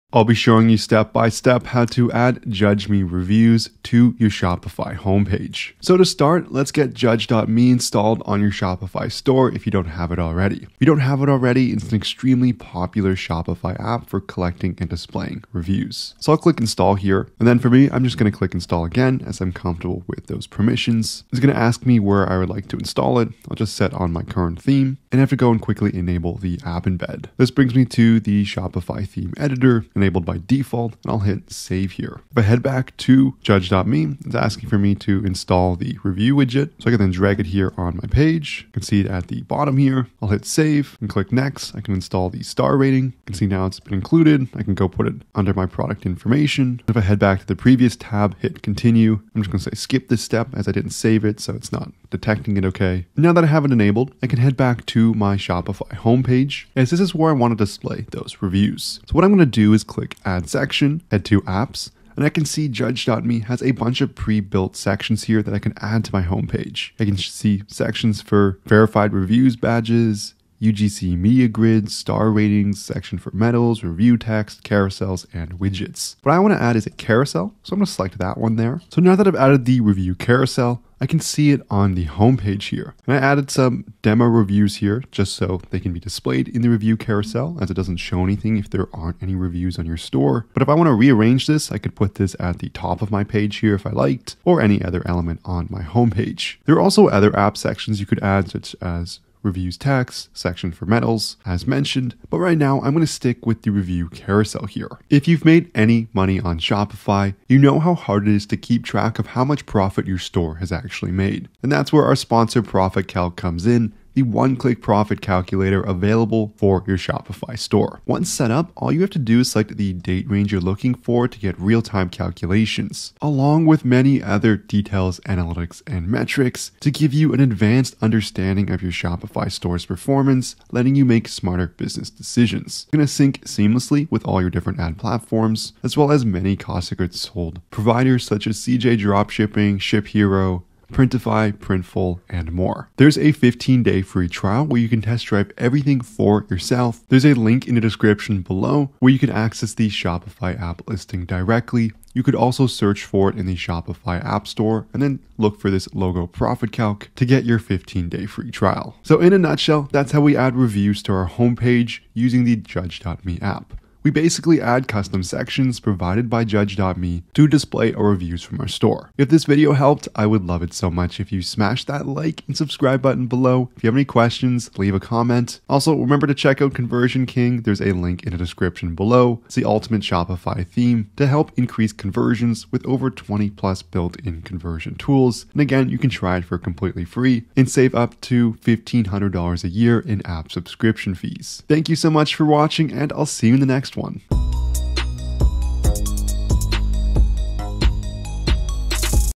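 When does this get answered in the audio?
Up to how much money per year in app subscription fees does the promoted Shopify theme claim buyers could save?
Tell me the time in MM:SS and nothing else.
03:08.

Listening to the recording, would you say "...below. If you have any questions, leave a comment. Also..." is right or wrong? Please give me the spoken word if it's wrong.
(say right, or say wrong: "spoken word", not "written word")
right.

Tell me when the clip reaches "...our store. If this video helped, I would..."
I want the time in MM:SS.
02:48.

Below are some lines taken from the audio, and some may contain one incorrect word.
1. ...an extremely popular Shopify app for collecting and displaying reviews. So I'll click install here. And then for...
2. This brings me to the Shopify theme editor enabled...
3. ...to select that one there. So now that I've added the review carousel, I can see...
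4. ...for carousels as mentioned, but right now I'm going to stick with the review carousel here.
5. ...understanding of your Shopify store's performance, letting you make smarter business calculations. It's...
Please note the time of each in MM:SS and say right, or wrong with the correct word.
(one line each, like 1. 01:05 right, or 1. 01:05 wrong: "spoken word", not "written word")
1. 00:11 right
2. 00:27 right
3. 01:17 right
4. 01:40 wrong: "medals", not "carousels"
5. 02:08 wrong: "decisions", not "calculations".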